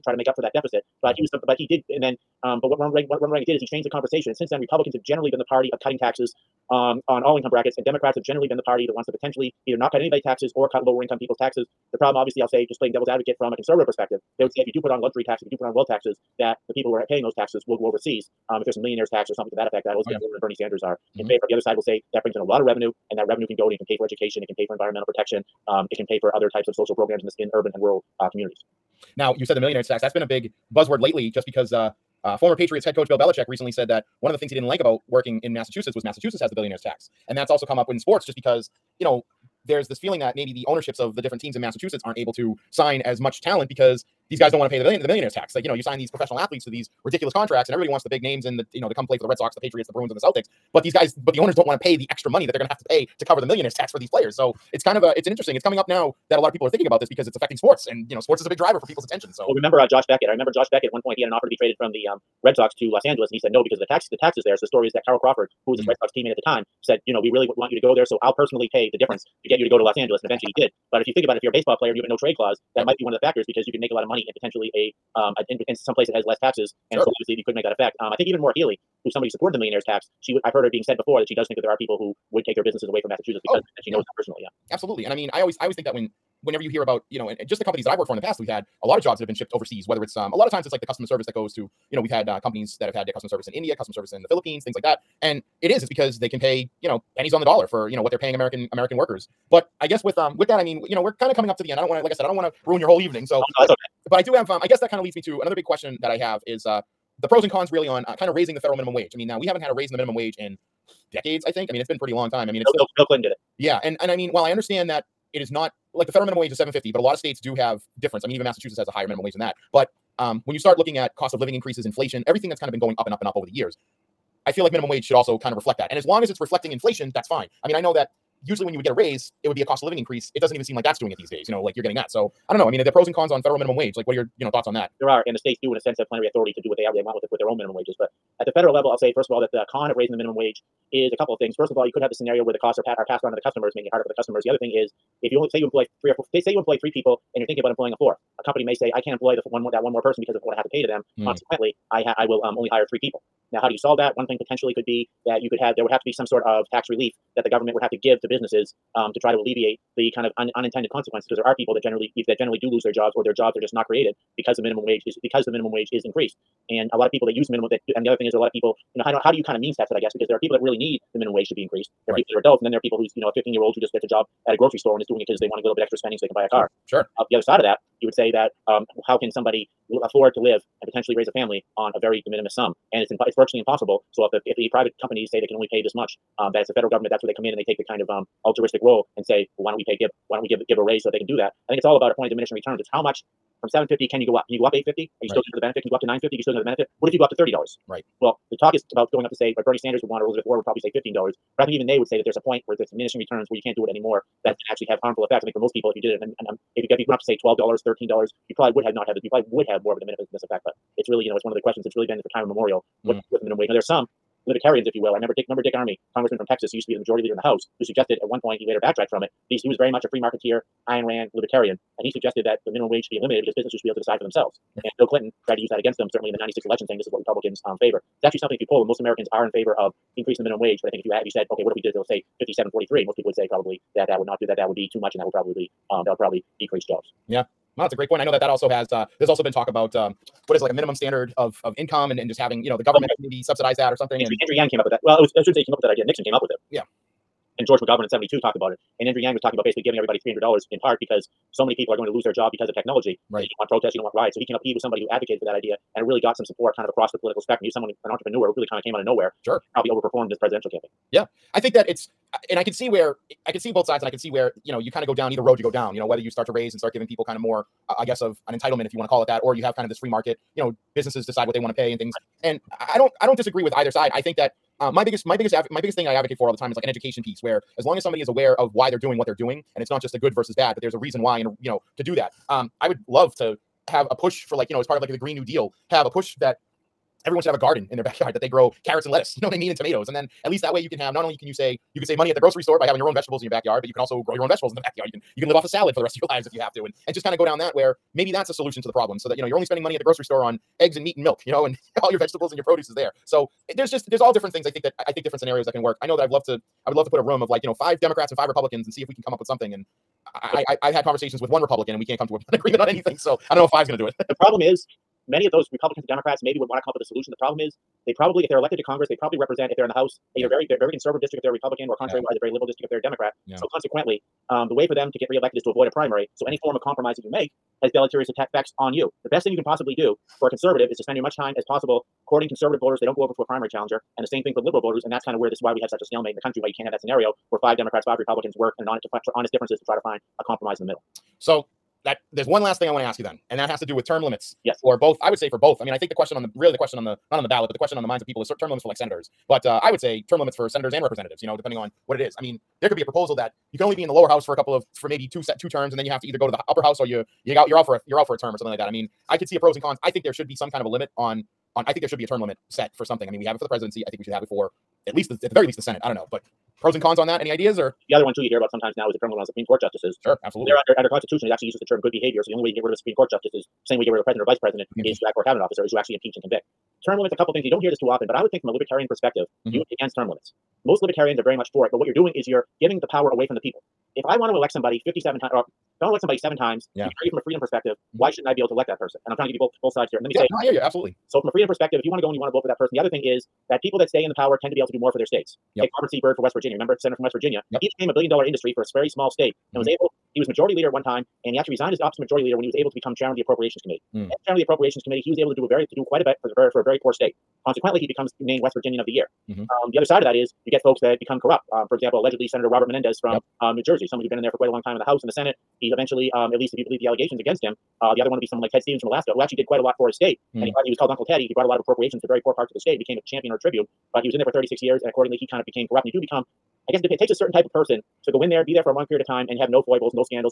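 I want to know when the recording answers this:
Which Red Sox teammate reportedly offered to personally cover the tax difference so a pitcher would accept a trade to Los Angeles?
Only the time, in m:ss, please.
1:05.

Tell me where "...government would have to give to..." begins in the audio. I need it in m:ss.
2:37.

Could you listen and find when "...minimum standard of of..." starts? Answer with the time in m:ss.
4:00.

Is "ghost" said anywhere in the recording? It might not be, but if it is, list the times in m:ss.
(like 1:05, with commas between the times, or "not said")
not said.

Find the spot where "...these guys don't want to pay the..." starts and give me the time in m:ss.
0:44.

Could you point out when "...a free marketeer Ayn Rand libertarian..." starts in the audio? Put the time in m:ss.
3:40.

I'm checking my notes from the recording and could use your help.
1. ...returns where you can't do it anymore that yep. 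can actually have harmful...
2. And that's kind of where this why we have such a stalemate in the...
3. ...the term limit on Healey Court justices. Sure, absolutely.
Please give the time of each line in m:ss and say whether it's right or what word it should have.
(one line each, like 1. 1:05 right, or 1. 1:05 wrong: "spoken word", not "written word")
1. 3:23 right
2. 5:35 right
3. 6:09 wrong: "Supreme", not "Healey".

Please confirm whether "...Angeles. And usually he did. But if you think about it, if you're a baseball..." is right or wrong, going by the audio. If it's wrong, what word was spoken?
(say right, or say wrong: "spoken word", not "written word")
wrong: "eventually", not "usually".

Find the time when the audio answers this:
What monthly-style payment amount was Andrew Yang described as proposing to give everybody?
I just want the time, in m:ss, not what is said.
4:10.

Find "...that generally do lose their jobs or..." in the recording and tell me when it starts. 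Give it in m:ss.
2:42.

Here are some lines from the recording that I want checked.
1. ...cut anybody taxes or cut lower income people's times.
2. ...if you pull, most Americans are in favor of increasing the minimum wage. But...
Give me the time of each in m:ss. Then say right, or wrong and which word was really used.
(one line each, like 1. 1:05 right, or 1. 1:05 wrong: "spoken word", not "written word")
1. 0:09 wrong: "taxes", not "times"
2. 3:48 right.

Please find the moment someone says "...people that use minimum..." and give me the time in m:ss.
2:47.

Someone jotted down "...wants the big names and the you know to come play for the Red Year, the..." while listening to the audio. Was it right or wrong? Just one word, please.
wrong.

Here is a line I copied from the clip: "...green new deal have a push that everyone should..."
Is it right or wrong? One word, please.
right.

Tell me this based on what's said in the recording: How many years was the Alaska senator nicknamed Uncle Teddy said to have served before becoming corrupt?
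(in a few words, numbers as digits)
36.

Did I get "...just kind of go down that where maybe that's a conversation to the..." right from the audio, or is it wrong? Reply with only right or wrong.
wrong.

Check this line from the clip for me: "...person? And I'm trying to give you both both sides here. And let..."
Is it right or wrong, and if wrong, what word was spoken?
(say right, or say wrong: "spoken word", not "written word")
right.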